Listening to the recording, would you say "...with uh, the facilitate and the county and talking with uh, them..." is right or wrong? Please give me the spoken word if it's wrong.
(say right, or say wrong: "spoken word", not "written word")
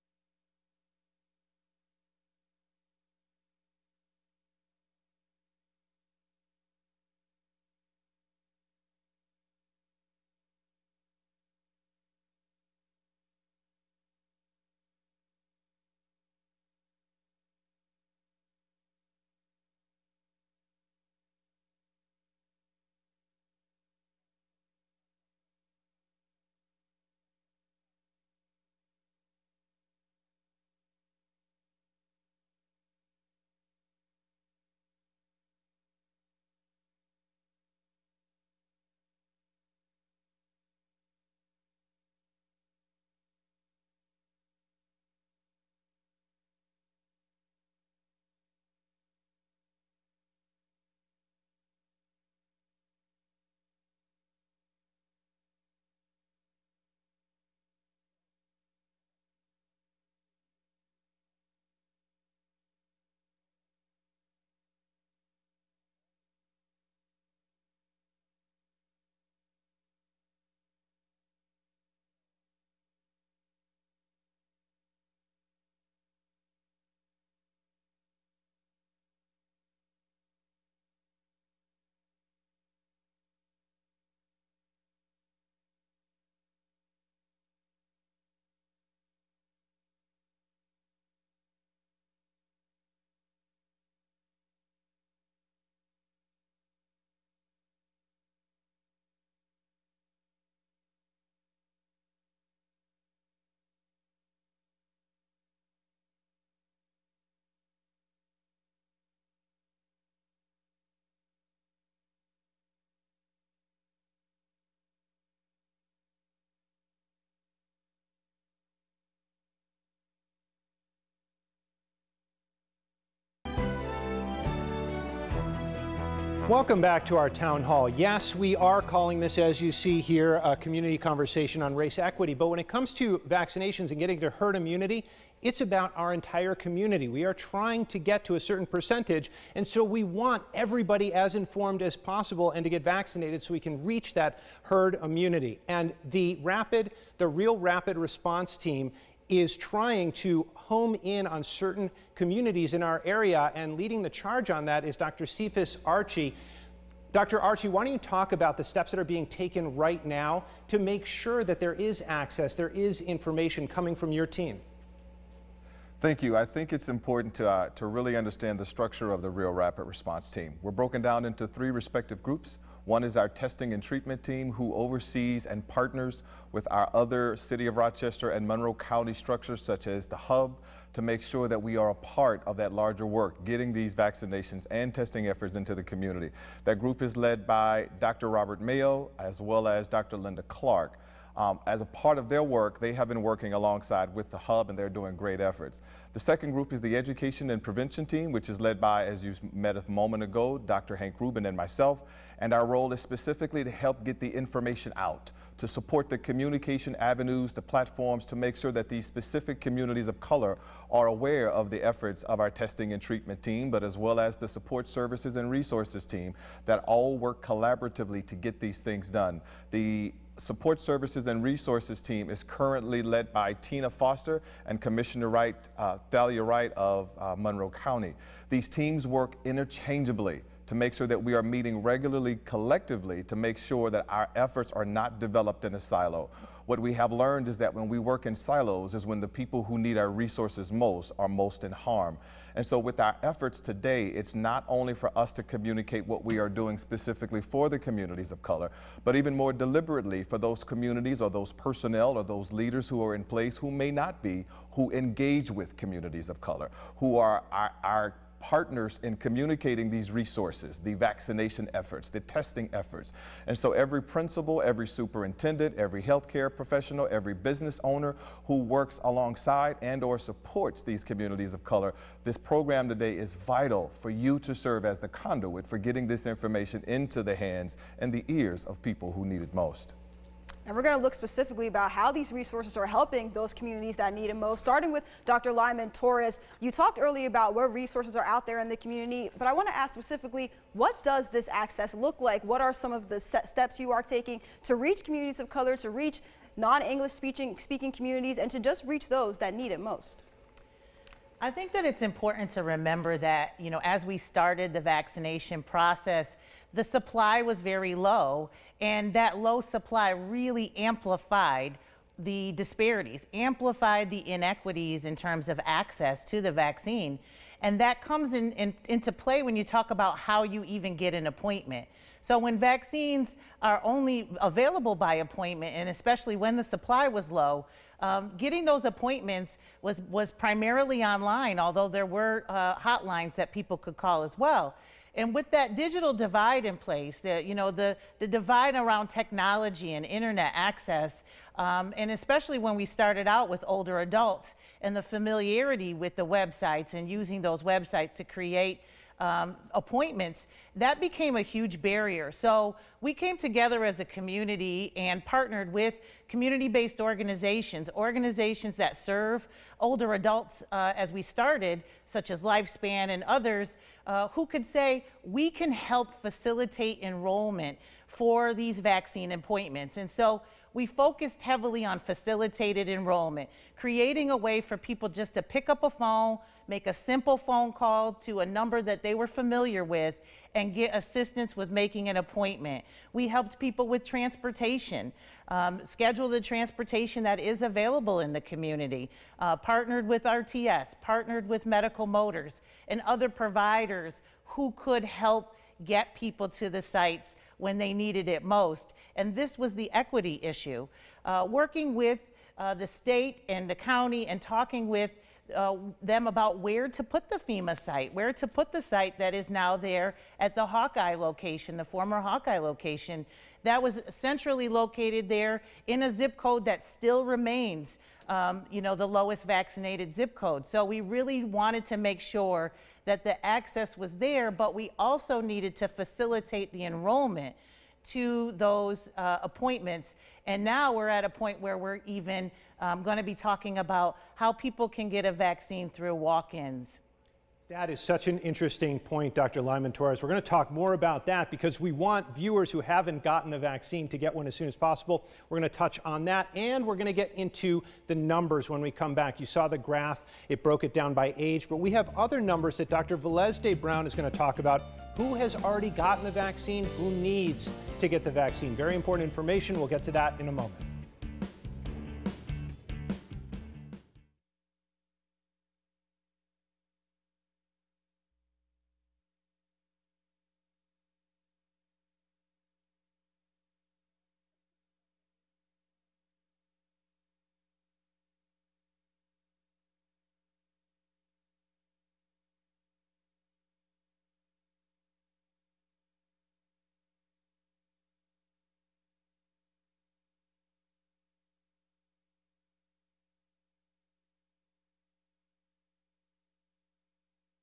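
wrong: "state", not "facilitate".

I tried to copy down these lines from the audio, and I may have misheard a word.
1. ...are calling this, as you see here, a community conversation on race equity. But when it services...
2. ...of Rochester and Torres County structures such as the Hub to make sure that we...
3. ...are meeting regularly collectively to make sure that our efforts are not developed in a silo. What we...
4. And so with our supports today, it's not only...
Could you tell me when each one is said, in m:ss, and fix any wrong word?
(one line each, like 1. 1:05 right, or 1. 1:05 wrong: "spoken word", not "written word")
1. 2:08 wrong: "comes", not "services"
2. 2:57 wrong: "Monroe", not "Torres"
3. 3:51 right
4. 4:02 wrong: "efforts", not "supports".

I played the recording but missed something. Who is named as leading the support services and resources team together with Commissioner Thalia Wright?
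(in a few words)
Tina Foster.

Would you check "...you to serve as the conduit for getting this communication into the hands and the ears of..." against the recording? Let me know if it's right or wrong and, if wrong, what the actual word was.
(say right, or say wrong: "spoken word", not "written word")
wrong: "information", not "communication".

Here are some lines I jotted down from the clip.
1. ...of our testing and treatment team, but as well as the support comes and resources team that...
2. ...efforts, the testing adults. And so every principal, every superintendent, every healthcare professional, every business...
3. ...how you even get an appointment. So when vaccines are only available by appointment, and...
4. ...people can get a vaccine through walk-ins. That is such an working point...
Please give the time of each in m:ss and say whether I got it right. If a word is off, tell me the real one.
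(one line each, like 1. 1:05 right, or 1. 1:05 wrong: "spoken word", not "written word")
1. 3:32 wrong: "services", not "comes"
2. 4:21 wrong: "efforts", not "adults"
3. 5:20 right
4. 7:14 wrong: "interesting", not "working".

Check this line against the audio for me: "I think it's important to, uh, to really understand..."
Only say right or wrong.
right.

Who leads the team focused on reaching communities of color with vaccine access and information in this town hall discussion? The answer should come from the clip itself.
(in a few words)
Dr. Cephas Archie.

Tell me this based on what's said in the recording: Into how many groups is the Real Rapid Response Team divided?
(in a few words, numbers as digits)
3.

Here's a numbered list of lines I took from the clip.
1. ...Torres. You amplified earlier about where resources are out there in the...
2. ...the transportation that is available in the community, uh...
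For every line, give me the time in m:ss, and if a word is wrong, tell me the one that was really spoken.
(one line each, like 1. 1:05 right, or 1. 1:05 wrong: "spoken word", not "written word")
1. 4:45 wrong: "talked", not "amplified"
2. 6:26 right.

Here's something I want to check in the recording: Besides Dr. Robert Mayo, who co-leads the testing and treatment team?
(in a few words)
Dr. Linda Clark.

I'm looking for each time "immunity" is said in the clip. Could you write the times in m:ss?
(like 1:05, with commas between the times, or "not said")
2:14, 2:25.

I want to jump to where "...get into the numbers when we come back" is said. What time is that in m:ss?
7:27.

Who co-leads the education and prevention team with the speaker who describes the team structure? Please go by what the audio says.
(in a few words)
Dr. Hank Rubin.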